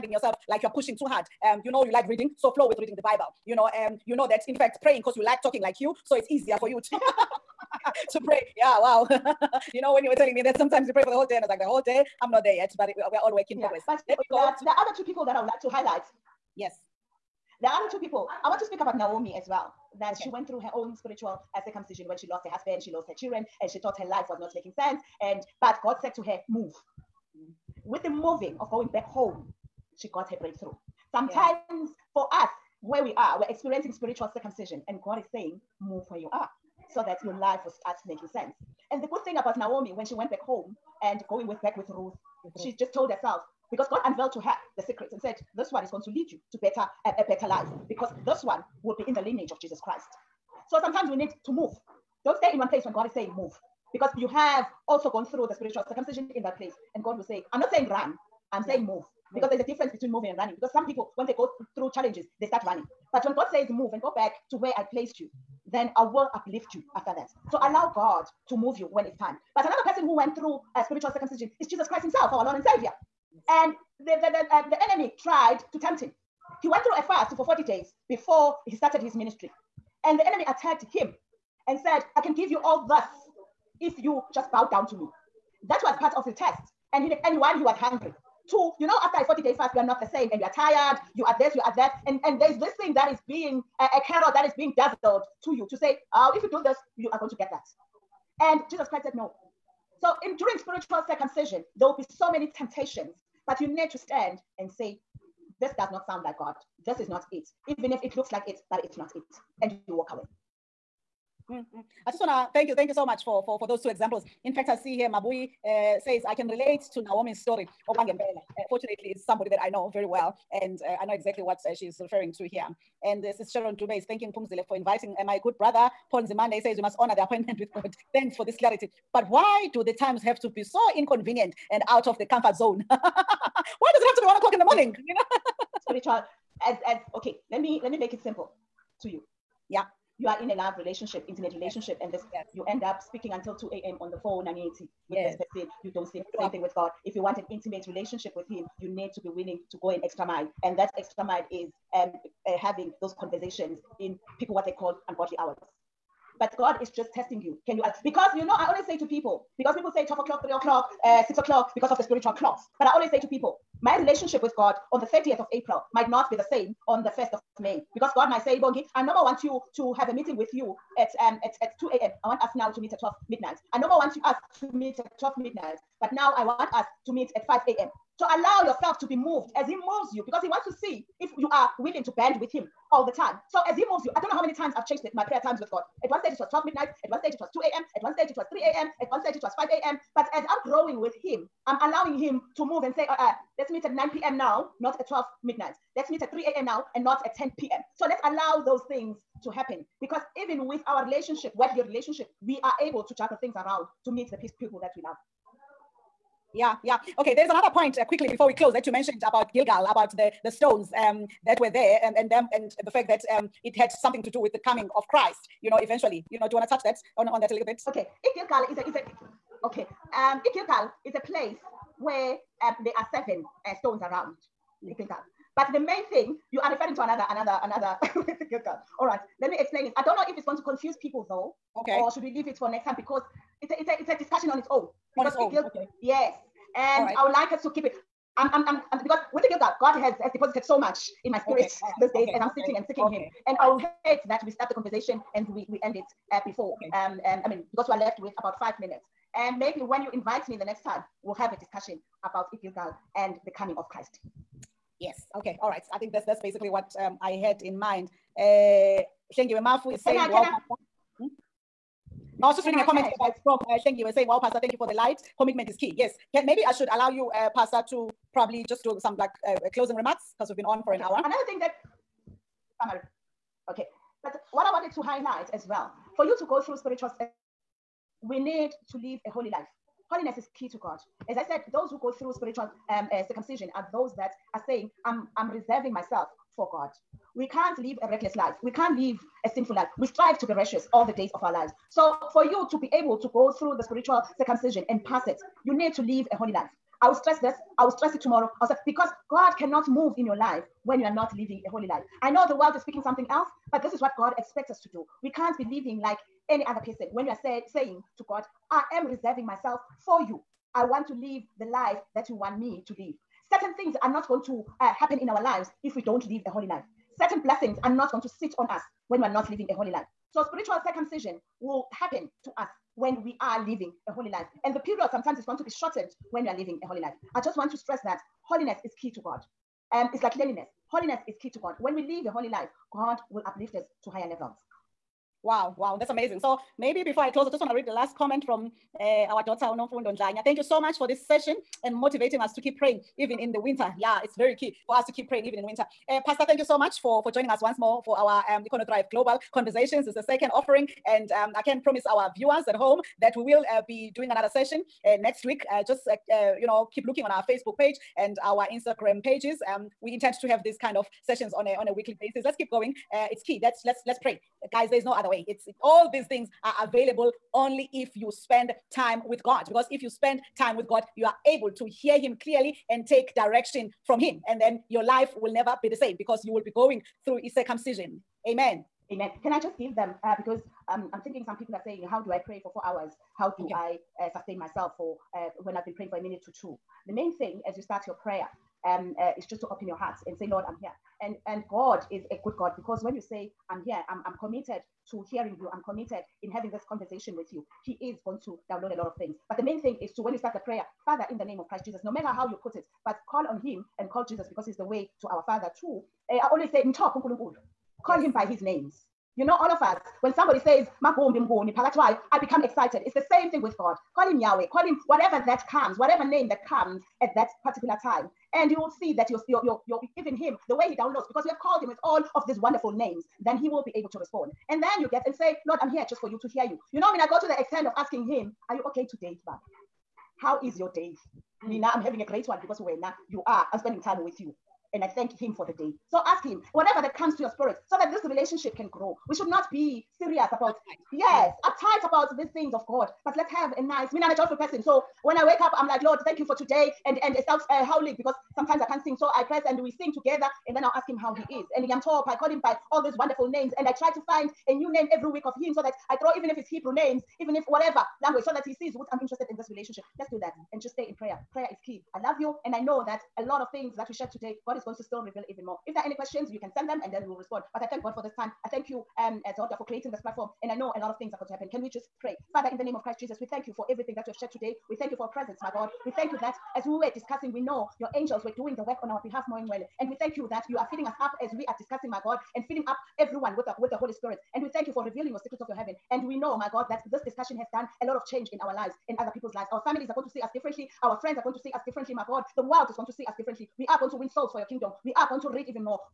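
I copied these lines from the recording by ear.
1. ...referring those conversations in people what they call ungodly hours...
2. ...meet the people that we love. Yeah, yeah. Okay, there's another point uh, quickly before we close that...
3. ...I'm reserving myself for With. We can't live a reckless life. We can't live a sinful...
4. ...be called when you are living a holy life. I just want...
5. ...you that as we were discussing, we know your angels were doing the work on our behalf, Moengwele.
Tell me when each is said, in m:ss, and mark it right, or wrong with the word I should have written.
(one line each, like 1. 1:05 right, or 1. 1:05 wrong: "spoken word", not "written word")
1. 2:32 wrong: "having", not "referring"
2. 3:24 right
3. 4:45 wrong: "God", not "With"
4. 5:25 wrong: "shortened", not "called"
5. 7:56 right.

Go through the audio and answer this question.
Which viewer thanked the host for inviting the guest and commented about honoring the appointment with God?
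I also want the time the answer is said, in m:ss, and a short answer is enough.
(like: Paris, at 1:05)
Sharon Dube, at 2:03.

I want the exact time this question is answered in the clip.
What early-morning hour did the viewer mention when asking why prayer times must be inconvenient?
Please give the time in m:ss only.
2:14.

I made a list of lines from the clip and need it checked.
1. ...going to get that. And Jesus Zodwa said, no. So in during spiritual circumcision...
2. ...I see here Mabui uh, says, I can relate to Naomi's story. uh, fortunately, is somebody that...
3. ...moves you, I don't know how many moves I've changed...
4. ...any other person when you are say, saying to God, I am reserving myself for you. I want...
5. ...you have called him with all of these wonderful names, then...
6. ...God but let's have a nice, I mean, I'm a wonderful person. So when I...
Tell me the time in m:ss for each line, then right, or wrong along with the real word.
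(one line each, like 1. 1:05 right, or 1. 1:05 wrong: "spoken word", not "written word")
1. 1:37 wrong: "Christ", not "Zodwa"
2. 1:54 right
3. 3:03 wrong: "times", not "moves"
4. 5:06 right
5. 7:01 right
6. 7:22 wrong: "joyful", not "wonderful".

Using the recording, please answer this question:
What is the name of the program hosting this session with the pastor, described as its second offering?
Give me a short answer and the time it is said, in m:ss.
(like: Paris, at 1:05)
Thrive Global Conversations, at 5:48.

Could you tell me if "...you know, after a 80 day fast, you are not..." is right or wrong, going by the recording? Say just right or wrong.
wrong.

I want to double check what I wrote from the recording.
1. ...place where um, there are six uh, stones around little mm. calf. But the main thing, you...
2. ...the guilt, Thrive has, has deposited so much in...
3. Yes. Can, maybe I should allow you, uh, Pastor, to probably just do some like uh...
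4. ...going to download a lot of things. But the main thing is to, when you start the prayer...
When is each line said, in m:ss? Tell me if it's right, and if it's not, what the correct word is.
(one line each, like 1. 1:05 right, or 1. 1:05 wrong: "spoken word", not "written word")
1. 3:41 wrong: "seven", not "six"
2. 3:59 wrong: "God", not "Thrive"
3. 4:25 right
4. 6:38 right.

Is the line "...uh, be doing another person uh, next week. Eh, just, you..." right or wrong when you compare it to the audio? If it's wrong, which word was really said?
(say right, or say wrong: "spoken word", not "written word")
wrong: "session", not "person".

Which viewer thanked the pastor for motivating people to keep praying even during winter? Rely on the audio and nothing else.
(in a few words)
Unomfundo Ndlanya.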